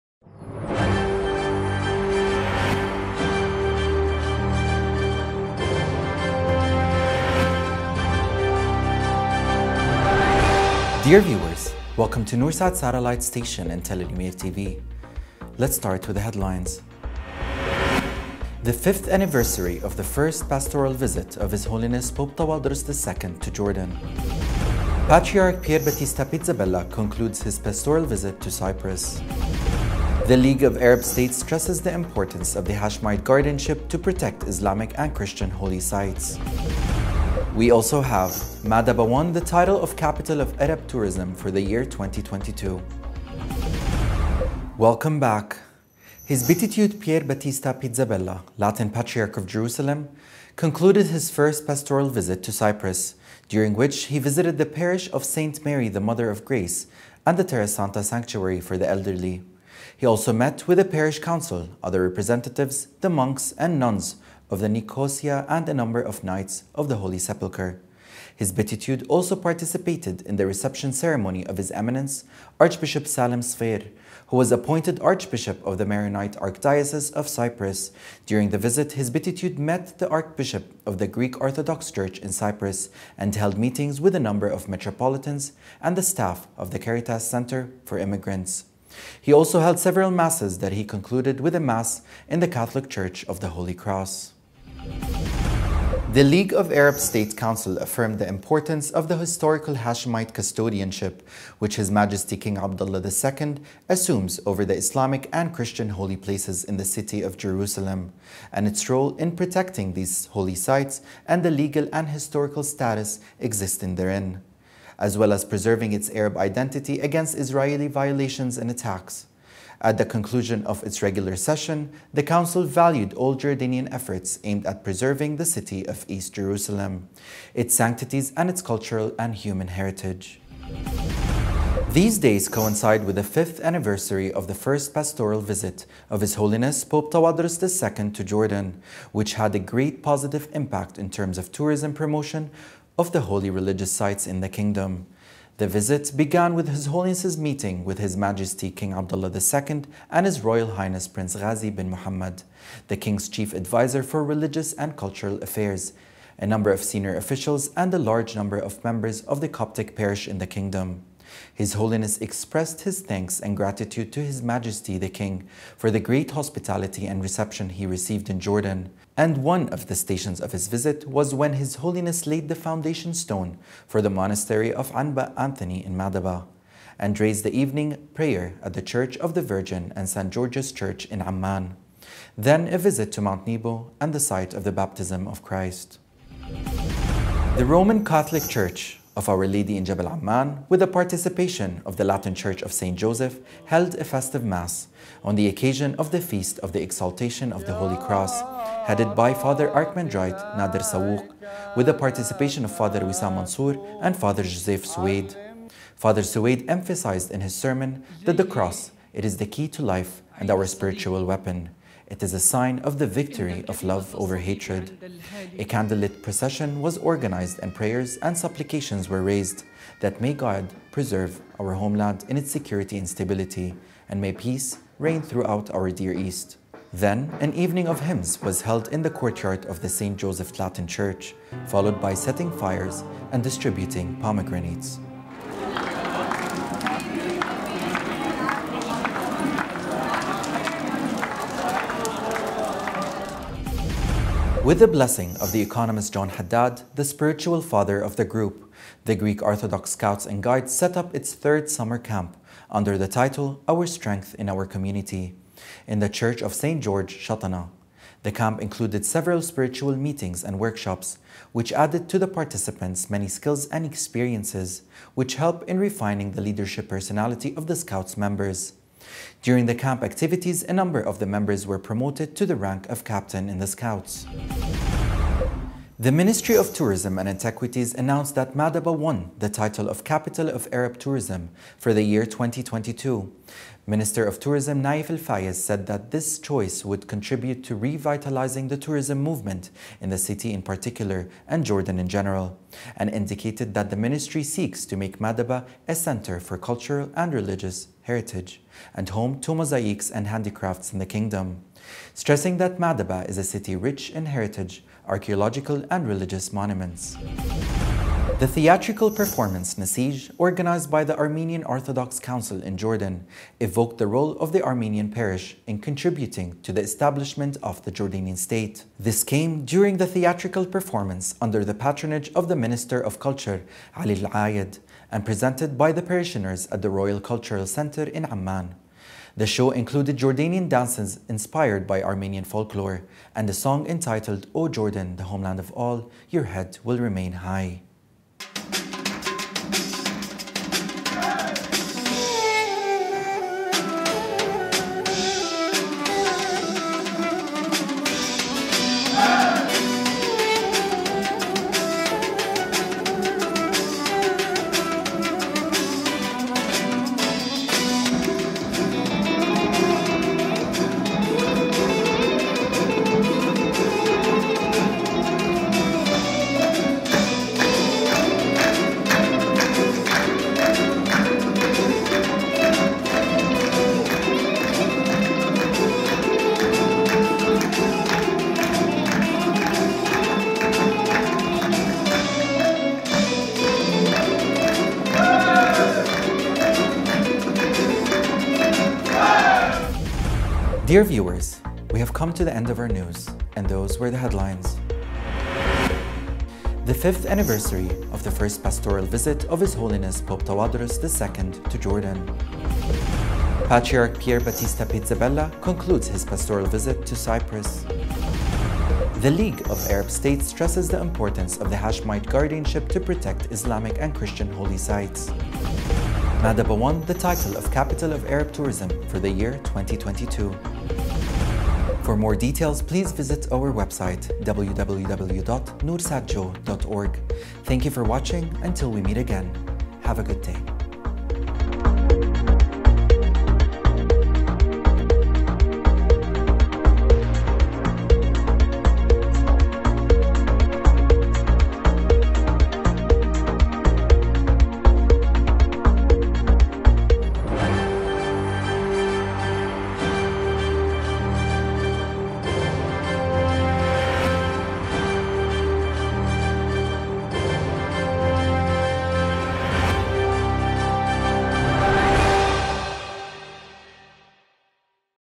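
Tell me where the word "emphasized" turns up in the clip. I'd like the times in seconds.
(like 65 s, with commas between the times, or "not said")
206 s.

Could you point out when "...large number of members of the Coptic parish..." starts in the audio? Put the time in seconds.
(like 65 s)
157 s.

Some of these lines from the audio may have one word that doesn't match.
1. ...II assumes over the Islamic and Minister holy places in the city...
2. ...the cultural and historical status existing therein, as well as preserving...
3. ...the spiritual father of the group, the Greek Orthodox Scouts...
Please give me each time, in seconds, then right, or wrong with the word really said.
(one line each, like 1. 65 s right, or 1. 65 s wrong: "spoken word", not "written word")
1. 103 s wrong: "Christian", not "Minister"
2. 111 s wrong: "legal", not "cultural"
3. 246 s right.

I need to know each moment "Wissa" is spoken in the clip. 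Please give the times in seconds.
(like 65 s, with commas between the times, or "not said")
203 s.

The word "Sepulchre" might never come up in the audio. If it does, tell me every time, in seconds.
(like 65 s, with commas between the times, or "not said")
67 s.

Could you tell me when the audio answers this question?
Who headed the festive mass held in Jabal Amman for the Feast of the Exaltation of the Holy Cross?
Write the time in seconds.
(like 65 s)
200 s.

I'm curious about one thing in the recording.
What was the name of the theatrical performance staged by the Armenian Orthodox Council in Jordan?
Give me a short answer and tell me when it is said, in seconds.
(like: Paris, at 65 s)
Nasij, at 309 s.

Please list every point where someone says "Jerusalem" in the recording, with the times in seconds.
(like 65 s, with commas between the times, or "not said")
49 s, 107 s, 126 s.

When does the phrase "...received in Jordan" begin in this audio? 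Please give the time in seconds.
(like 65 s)
167 s.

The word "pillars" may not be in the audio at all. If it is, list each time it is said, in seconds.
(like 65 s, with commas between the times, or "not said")
not said.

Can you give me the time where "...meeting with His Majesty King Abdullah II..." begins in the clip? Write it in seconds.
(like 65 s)
147 s.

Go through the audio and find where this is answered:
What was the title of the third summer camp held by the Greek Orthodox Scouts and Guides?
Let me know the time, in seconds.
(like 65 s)
253 s.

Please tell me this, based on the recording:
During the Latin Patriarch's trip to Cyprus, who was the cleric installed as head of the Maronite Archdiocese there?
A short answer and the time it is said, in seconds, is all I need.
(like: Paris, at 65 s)
Salim Sfeir, at 73 s.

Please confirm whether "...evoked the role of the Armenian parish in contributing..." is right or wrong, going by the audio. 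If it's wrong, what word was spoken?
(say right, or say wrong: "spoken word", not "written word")
right.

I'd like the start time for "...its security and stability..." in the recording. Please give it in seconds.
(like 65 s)
222 s.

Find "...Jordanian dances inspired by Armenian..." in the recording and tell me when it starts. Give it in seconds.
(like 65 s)
330 s.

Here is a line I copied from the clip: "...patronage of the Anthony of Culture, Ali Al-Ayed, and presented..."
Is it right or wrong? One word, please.
wrong.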